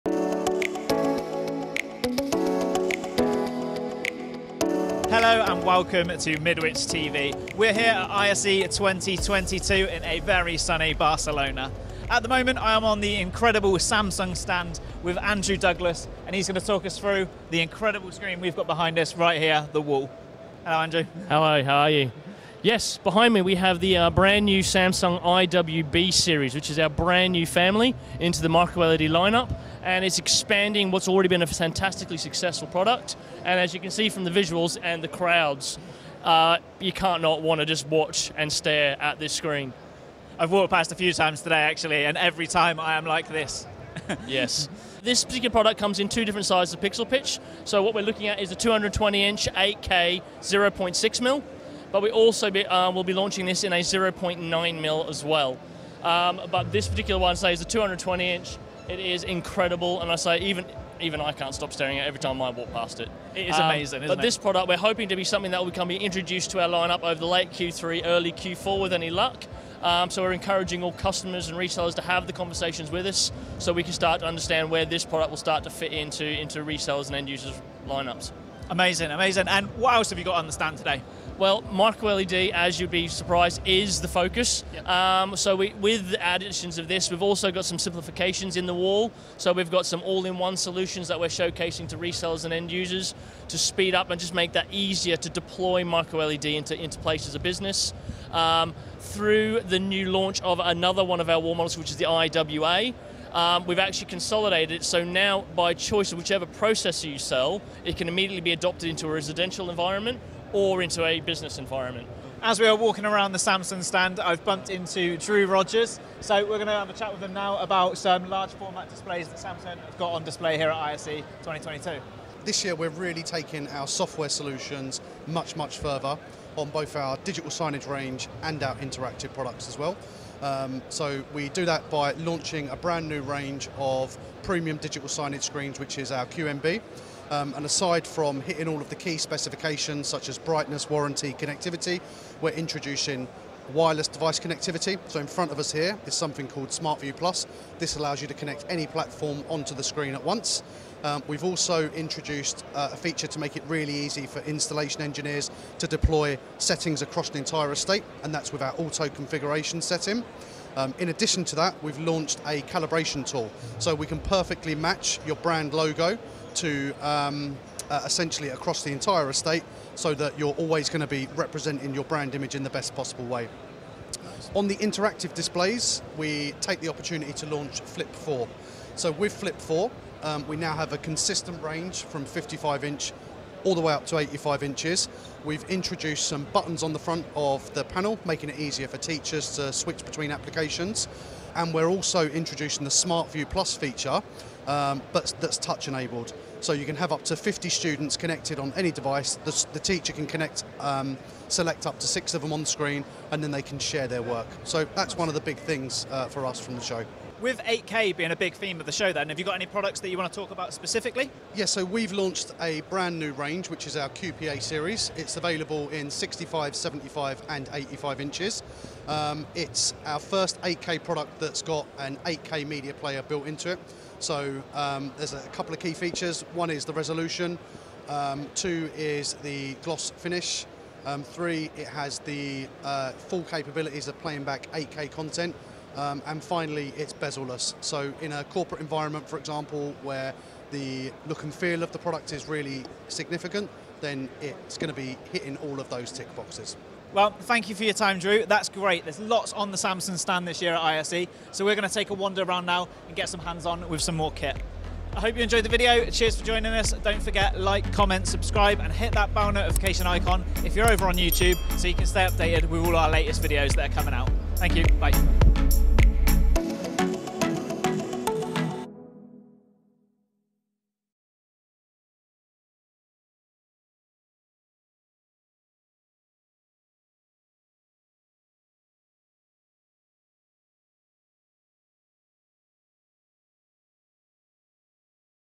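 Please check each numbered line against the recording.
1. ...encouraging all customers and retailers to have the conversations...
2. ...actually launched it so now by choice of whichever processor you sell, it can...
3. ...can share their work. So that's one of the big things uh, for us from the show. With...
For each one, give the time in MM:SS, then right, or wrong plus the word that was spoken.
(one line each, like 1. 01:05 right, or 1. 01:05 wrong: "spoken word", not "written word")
1. 01:10 right
2. 01:43 wrong: "consolidated", not "launched"
3. 03:23 right.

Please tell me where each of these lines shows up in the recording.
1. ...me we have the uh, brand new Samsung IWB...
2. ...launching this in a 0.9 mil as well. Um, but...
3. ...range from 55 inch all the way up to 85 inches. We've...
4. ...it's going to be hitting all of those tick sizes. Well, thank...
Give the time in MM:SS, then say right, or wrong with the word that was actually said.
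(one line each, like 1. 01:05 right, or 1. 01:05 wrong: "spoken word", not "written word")
1. 00:23 right
2. 00:53 right
3. 03:01 right
4. 04:04 wrong: "boxes", not "sizes".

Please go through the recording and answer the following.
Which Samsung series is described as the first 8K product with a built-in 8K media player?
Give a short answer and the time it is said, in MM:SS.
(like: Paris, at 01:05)
QPA series, at 03:34.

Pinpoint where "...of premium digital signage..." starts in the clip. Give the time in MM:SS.
02:13.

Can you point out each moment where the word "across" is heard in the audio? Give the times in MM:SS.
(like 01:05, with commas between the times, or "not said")
02:37, 02:48.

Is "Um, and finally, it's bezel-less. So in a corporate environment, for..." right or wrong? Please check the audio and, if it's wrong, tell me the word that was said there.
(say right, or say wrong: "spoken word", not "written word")
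right.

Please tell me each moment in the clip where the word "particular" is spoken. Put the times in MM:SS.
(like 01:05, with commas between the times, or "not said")
00:45, 00:56.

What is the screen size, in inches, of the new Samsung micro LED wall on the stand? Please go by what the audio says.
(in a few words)
220 inch.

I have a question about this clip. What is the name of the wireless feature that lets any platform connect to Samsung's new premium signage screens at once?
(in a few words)
SmartView Plus.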